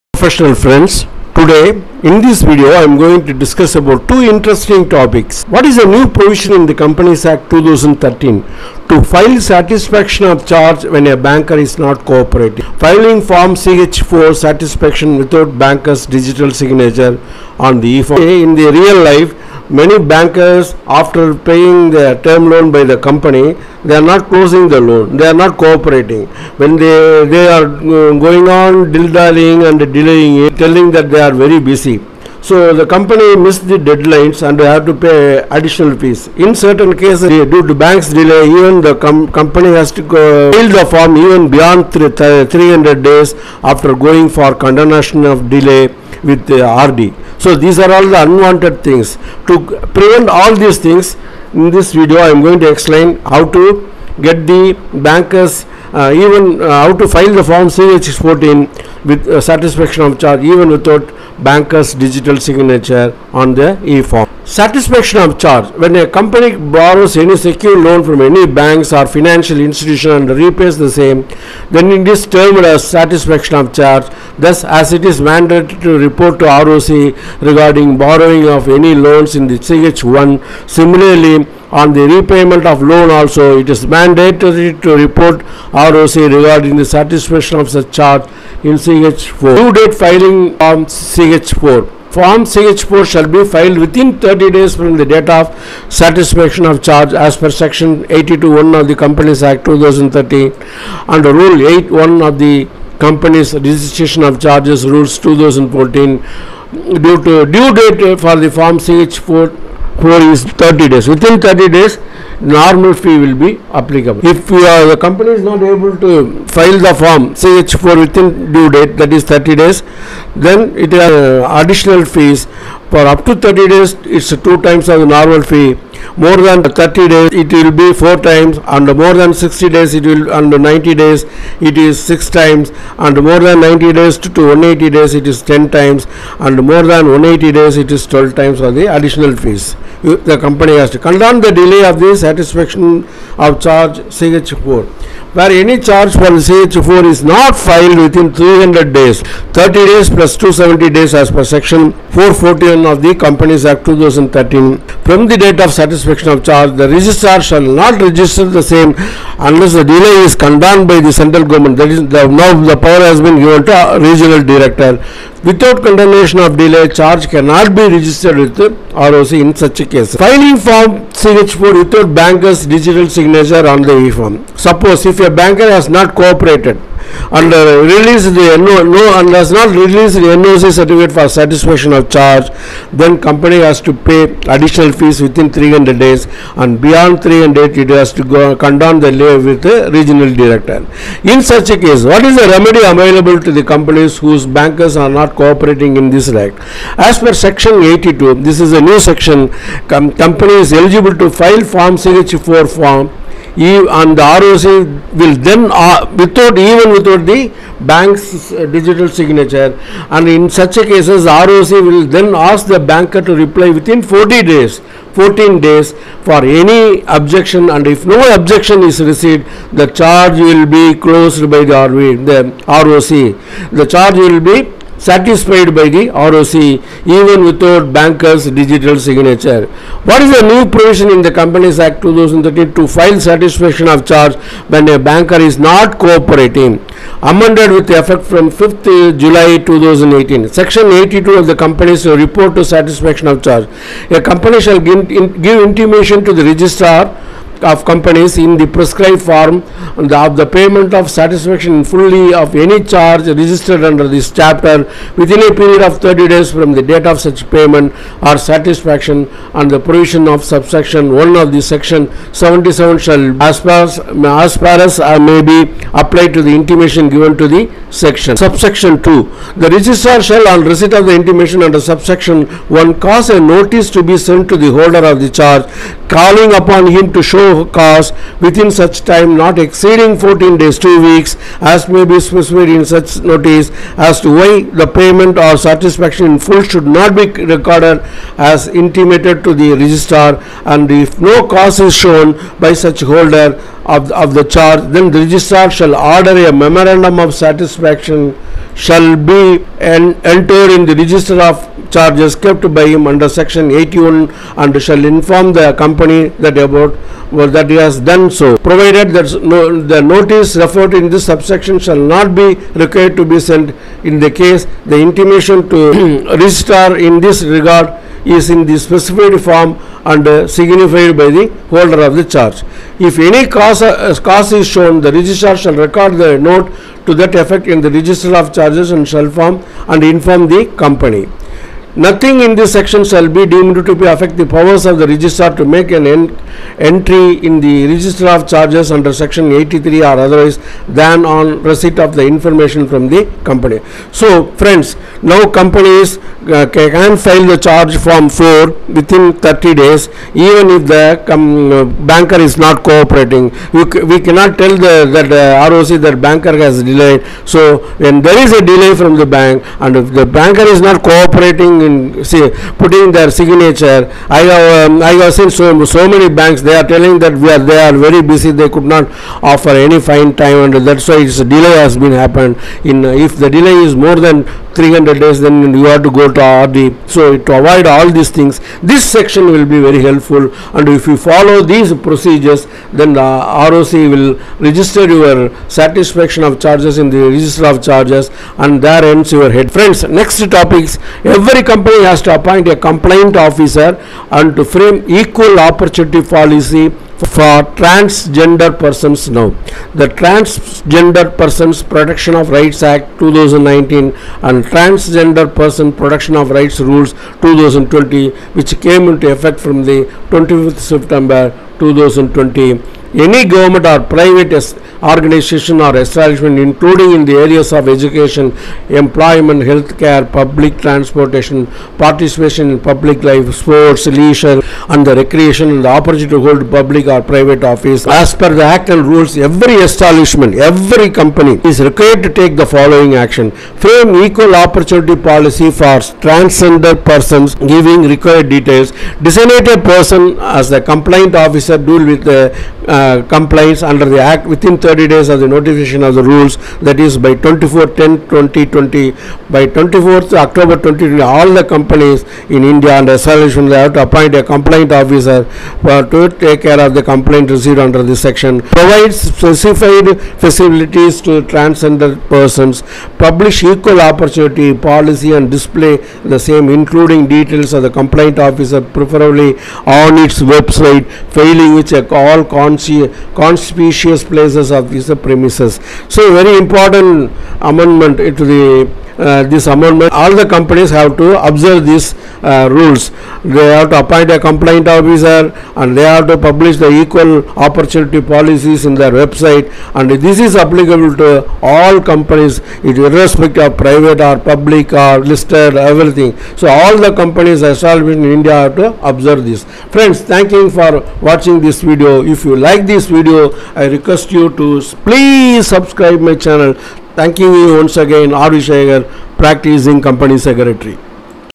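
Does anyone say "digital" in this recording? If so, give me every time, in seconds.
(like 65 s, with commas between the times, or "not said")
16 s, 61 s, 172 s, 208 s, 228 s.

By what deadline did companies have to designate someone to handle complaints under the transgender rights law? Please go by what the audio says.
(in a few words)
24th October 2020.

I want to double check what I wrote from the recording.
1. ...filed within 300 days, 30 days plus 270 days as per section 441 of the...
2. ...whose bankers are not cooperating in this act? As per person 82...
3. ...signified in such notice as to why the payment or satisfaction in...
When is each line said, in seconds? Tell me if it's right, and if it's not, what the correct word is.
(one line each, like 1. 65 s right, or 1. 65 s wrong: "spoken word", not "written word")
1. 147 s right
2. 194 s wrong: "section", not "person"
3. 282 s wrong: "specified", not "signified".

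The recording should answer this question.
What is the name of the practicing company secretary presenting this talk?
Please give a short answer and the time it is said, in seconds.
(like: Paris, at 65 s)
R. Vishayagar, at 508 s.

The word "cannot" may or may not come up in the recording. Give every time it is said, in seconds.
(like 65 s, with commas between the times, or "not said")
167 s, 354 s.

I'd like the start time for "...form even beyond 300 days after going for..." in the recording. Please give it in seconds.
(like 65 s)
40 s.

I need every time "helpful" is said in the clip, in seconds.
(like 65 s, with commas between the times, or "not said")
380 s.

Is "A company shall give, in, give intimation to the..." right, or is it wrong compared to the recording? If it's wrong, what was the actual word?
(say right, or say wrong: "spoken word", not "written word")
right.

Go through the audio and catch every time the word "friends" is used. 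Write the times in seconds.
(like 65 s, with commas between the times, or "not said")
0 s, 344 s, 389 s, 499 s.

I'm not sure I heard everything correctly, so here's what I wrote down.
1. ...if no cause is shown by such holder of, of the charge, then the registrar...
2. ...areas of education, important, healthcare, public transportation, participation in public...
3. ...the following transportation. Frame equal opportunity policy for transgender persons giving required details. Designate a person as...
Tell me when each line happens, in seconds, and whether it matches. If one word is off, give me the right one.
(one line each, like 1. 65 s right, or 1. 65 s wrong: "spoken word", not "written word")
1. 291 s right
2. 417 s wrong: "employment", not "important"
3. 432 s wrong: "action", not "transportation".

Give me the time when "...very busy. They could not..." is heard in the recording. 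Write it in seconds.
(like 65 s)
367 s.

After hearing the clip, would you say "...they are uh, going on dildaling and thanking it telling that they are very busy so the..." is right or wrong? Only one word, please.
wrong.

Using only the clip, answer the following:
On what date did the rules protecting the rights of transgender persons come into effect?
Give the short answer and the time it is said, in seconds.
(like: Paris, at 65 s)
25th September 2020, at 410 s.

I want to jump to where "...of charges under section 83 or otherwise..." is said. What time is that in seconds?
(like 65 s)
338 s.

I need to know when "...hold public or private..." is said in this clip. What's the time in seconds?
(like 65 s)
426 s.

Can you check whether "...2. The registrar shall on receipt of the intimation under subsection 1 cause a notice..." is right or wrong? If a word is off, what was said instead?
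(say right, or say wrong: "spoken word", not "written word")
right.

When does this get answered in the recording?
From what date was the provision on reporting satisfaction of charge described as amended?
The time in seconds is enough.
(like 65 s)
238 s.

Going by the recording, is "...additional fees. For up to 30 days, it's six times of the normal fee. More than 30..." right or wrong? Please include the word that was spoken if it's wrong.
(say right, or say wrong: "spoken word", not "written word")
wrong: "two", not "six".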